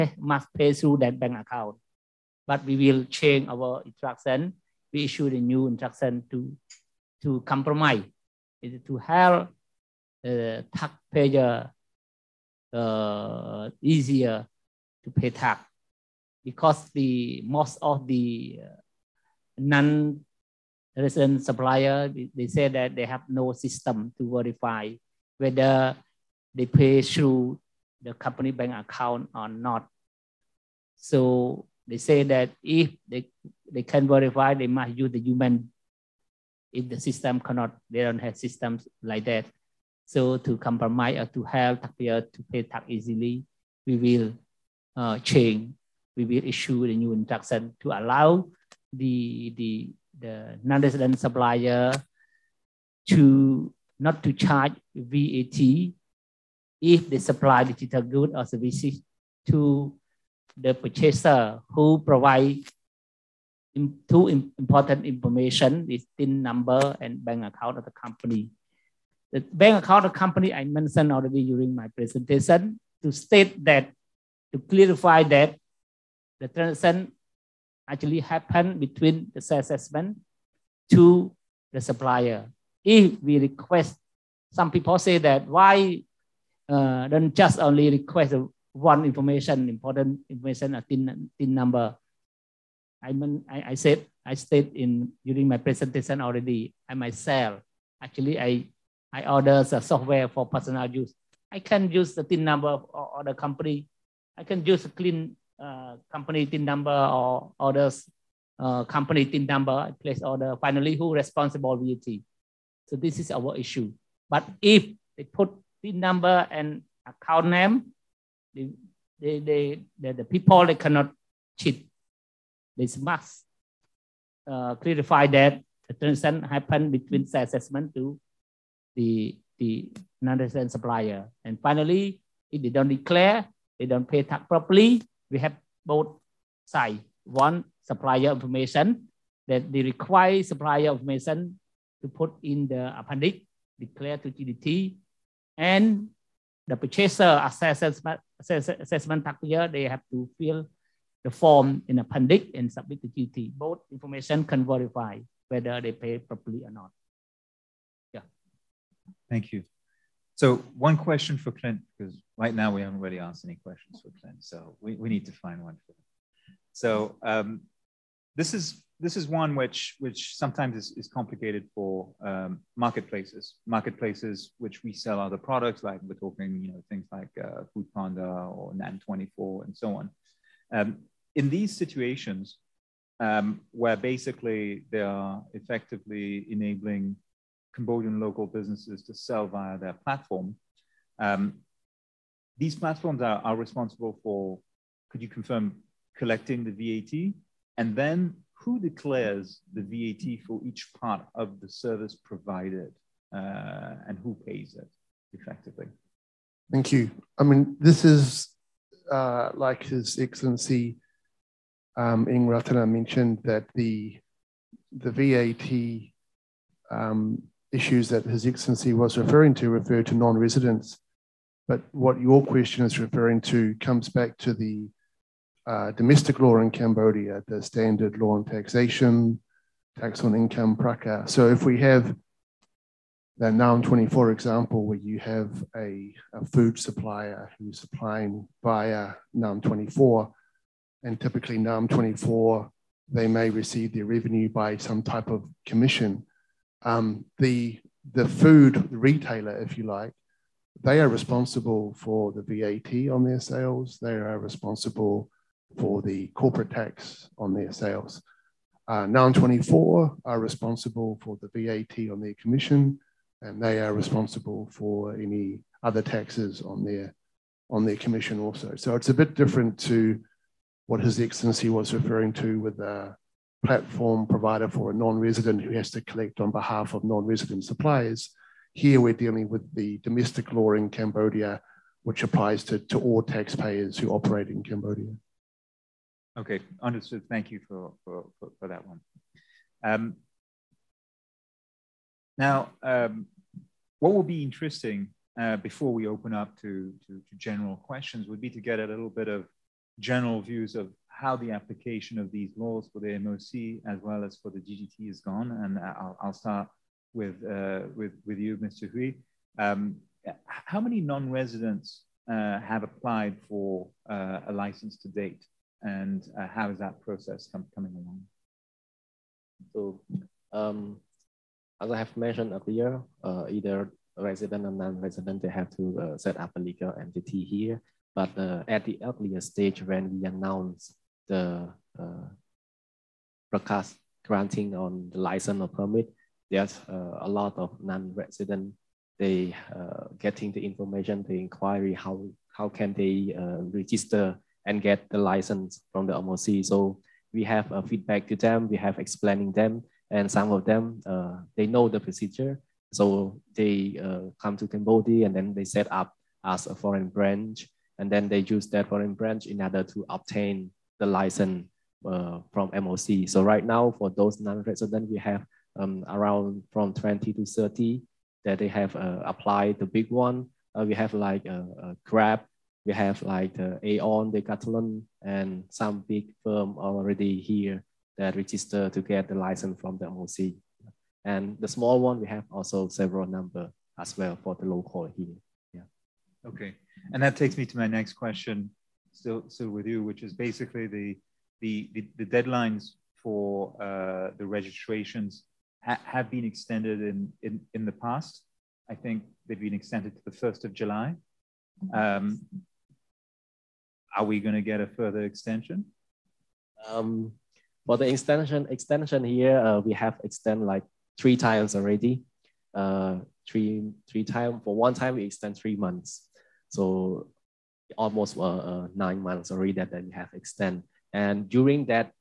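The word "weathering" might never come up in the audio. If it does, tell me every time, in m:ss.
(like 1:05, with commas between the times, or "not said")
not said.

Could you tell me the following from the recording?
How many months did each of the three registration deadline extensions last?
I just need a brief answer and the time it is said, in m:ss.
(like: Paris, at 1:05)
3 months, at 6:55.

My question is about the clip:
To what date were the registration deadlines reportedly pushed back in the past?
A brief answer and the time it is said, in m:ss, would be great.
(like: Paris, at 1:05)
1 July, at 6:40.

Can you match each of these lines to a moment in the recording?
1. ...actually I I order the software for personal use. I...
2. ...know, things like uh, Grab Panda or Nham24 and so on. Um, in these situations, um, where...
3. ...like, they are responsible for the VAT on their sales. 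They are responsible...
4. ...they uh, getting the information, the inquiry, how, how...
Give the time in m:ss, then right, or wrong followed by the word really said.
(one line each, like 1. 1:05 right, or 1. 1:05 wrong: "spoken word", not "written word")
1. 1:38 right
2. 2:56 wrong: "Food", not "Grab"
3. 4:09 right
4. 5:39 right.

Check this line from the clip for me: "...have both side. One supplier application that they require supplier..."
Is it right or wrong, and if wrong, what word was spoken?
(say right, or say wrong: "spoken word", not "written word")
wrong: "information", not "application".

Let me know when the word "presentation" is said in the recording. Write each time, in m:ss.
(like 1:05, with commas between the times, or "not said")
1:11, 1:35.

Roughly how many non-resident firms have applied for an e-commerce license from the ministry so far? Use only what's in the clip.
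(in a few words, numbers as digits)
20 to 30.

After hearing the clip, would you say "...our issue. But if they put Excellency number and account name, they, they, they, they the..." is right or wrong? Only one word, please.
wrong.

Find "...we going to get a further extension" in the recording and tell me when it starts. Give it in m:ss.
6:44.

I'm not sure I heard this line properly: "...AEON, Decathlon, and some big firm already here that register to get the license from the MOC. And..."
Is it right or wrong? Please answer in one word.
right.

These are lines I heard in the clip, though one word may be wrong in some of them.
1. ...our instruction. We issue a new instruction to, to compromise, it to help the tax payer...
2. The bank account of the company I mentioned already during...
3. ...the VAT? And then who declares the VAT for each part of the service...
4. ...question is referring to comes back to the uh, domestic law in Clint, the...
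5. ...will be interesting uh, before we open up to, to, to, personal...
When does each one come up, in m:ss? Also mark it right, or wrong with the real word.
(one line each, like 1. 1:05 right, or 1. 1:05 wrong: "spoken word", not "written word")
1. 0:03 right
2. 1:09 right
3. 3:16 right
4. 3:42 wrong: "Cambodia", not "Clint"
5. 4:54 wrong: "general", not "personal".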